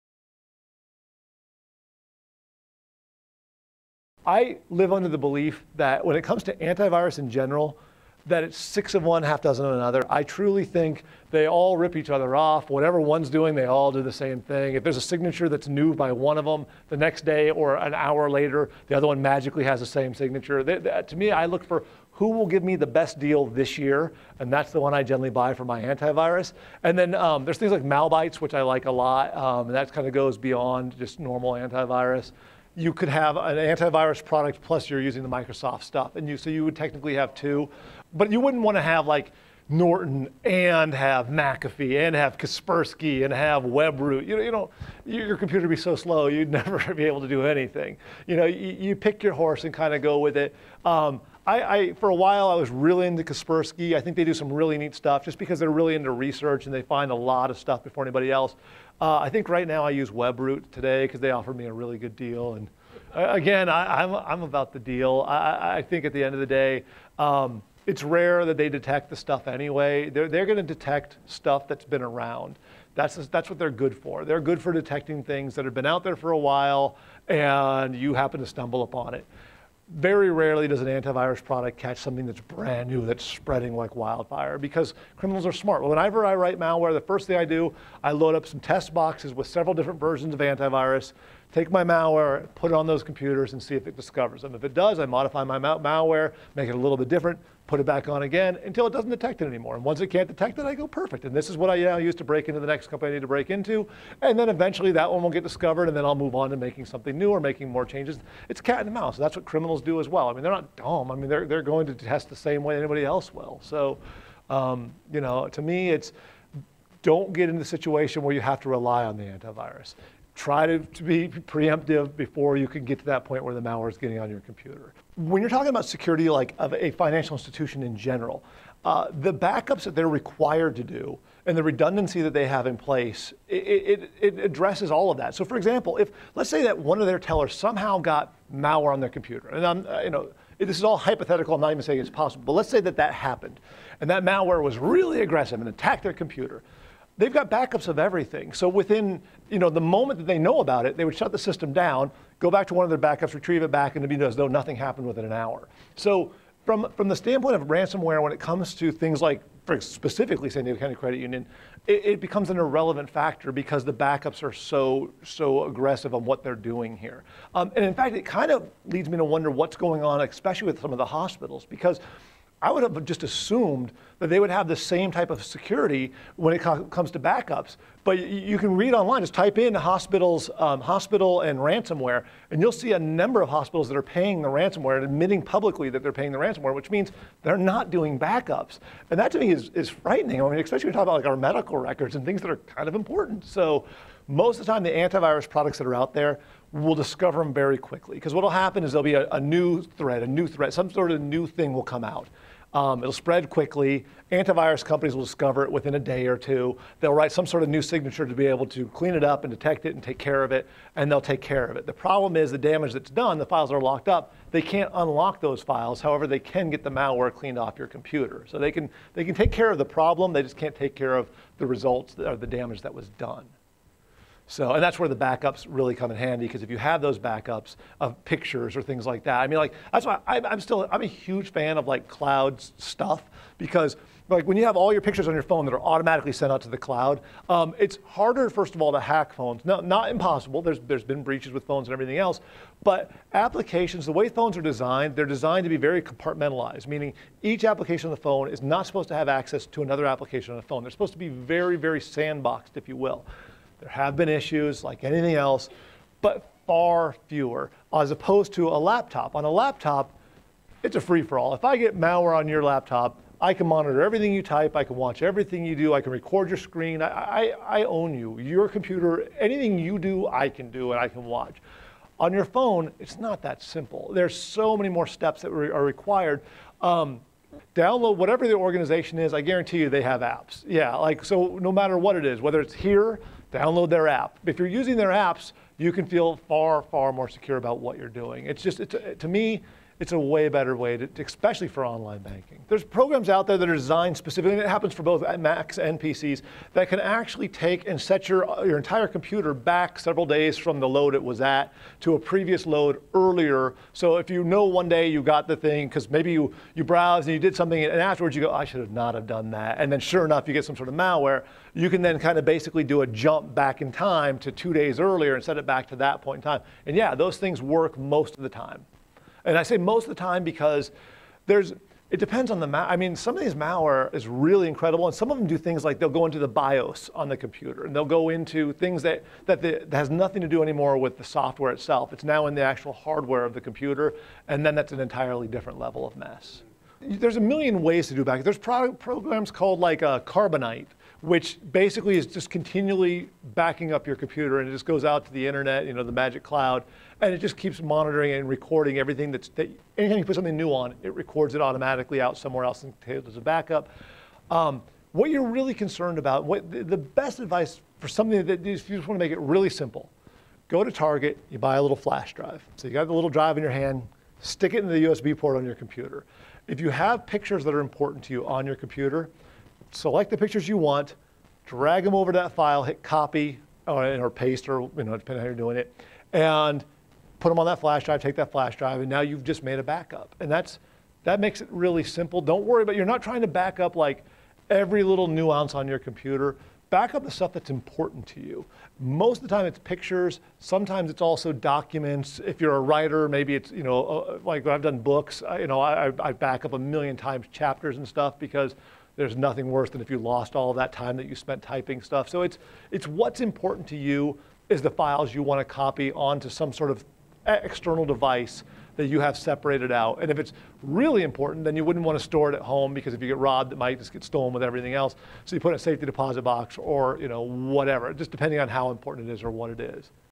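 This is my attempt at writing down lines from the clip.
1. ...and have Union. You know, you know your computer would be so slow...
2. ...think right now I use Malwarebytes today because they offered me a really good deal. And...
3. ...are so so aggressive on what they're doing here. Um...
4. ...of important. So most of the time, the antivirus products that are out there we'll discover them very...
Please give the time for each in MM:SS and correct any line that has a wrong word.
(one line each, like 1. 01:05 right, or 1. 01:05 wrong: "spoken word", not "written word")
1. 00:43 wrong: "WebRoot", not "Union"
2. 00:59 wrong: "WebRoot", not "Malwarebytes"
3. 02:44 right
4. 03:12 right.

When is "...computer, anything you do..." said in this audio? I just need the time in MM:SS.
04:28.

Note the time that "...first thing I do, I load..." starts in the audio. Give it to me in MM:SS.
01:27.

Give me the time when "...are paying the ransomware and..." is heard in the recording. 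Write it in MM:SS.
03:03.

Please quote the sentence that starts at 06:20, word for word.
And that's, that makes it really simple.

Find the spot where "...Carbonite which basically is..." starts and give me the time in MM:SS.
05:40.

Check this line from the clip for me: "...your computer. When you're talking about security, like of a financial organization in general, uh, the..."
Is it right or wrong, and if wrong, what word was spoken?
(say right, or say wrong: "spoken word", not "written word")
wrong: "institution", not "organization".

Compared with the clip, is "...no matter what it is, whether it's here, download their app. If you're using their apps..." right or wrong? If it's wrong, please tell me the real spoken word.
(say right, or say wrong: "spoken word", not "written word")
right.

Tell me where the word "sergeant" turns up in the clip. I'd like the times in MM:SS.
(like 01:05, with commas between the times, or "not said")
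not said.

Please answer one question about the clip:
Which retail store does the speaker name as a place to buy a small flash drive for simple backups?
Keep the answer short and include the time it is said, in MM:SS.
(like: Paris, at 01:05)
Target, at 06:00.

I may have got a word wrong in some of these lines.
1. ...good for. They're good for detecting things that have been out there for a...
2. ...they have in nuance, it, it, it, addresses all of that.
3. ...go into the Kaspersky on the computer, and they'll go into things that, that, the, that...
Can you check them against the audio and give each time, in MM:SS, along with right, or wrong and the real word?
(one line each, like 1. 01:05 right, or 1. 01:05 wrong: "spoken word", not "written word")
1. 01:13 right
2. 02:12 wrong: "place", not "nuance"
3. 05:26 wrong: "BIOS", not "Kaspersky".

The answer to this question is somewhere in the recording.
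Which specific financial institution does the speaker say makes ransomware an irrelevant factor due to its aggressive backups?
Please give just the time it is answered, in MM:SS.
02:40.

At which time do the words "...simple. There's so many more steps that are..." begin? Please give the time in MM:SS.
04:33.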